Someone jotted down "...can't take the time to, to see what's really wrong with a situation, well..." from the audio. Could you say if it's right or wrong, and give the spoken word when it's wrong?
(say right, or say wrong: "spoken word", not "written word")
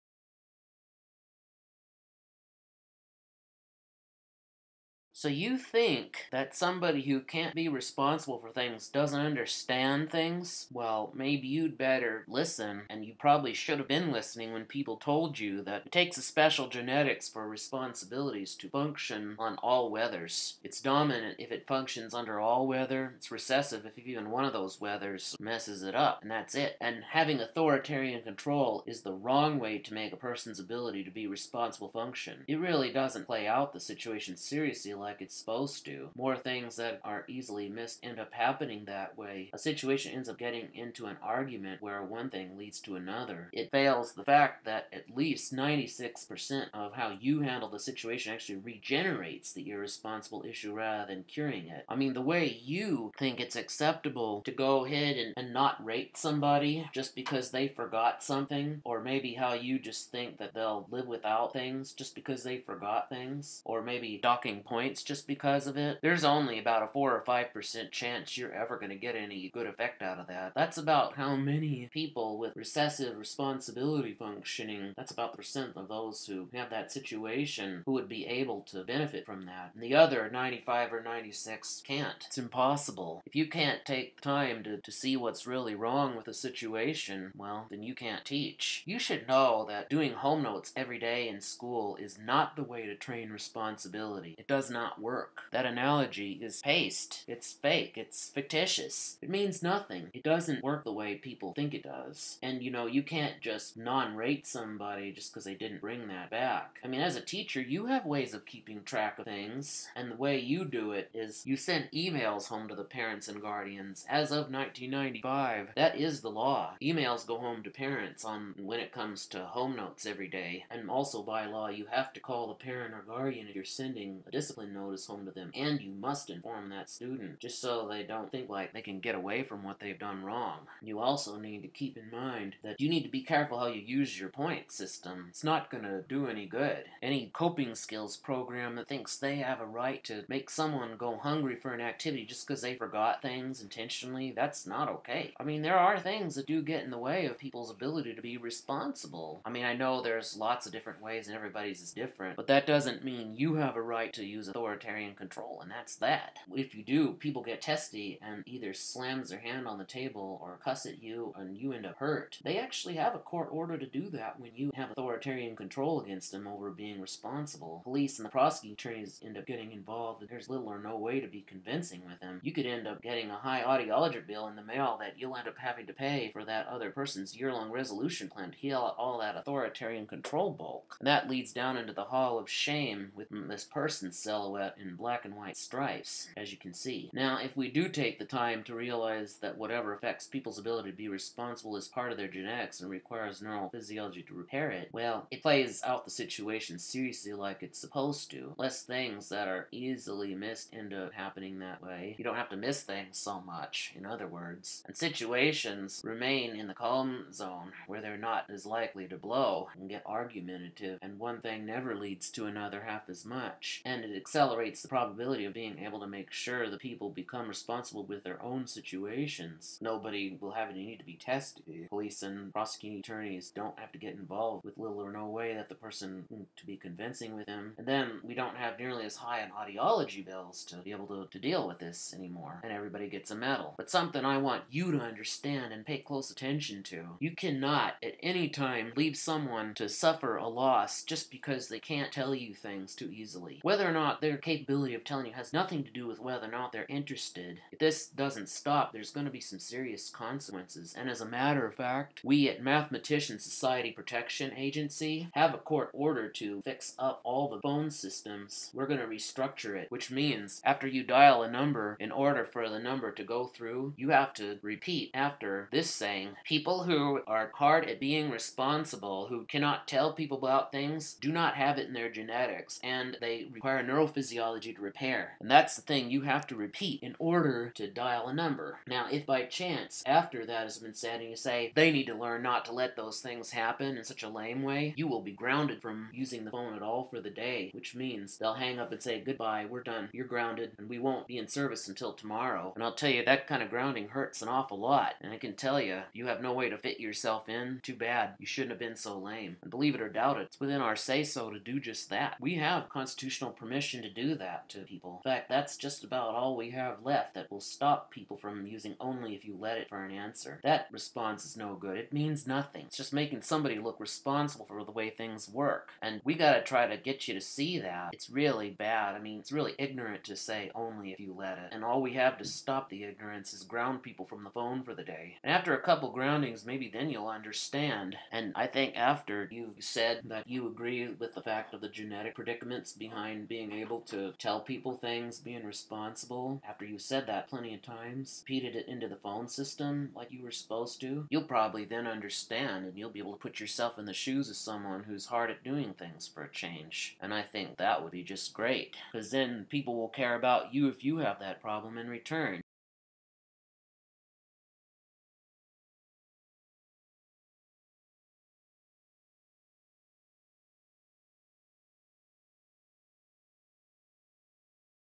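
right.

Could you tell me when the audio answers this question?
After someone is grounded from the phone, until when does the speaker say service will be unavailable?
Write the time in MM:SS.
04:52.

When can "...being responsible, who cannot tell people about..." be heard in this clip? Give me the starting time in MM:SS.
04:27.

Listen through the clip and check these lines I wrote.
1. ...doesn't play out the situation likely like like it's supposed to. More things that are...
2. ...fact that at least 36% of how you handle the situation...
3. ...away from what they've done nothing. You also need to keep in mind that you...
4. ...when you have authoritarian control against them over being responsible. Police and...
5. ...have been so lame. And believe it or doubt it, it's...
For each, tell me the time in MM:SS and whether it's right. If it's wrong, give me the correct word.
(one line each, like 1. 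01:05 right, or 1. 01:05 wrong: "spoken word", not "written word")
1. 00:32 wrong: "seriously", not "likely"
2. 00:44 wrong: "96", not "36"
3. 02:09 wrong: "wrong", not "nothing"
4. 02:44 right
5. 04:58 right.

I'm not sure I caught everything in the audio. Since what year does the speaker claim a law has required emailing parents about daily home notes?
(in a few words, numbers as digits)
1995.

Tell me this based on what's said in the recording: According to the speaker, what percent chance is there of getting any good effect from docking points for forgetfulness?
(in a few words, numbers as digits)
4 or 5%.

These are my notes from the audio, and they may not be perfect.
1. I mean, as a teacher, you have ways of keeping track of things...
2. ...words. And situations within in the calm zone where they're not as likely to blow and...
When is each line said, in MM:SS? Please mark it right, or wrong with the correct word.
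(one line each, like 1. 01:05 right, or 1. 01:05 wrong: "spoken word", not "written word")
1. 01:46 right
2. 03:24 wrong: "remain", not "within".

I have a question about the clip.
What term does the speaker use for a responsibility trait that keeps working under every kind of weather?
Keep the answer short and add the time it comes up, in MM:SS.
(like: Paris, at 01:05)
dominant, at 00:20.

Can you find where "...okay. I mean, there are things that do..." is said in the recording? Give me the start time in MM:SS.
02:24.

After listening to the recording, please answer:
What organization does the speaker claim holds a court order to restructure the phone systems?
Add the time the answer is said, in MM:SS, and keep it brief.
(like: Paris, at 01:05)
Mathematician Society Protection Agency, at 04:12.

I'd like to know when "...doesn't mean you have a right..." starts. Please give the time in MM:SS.
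02:32.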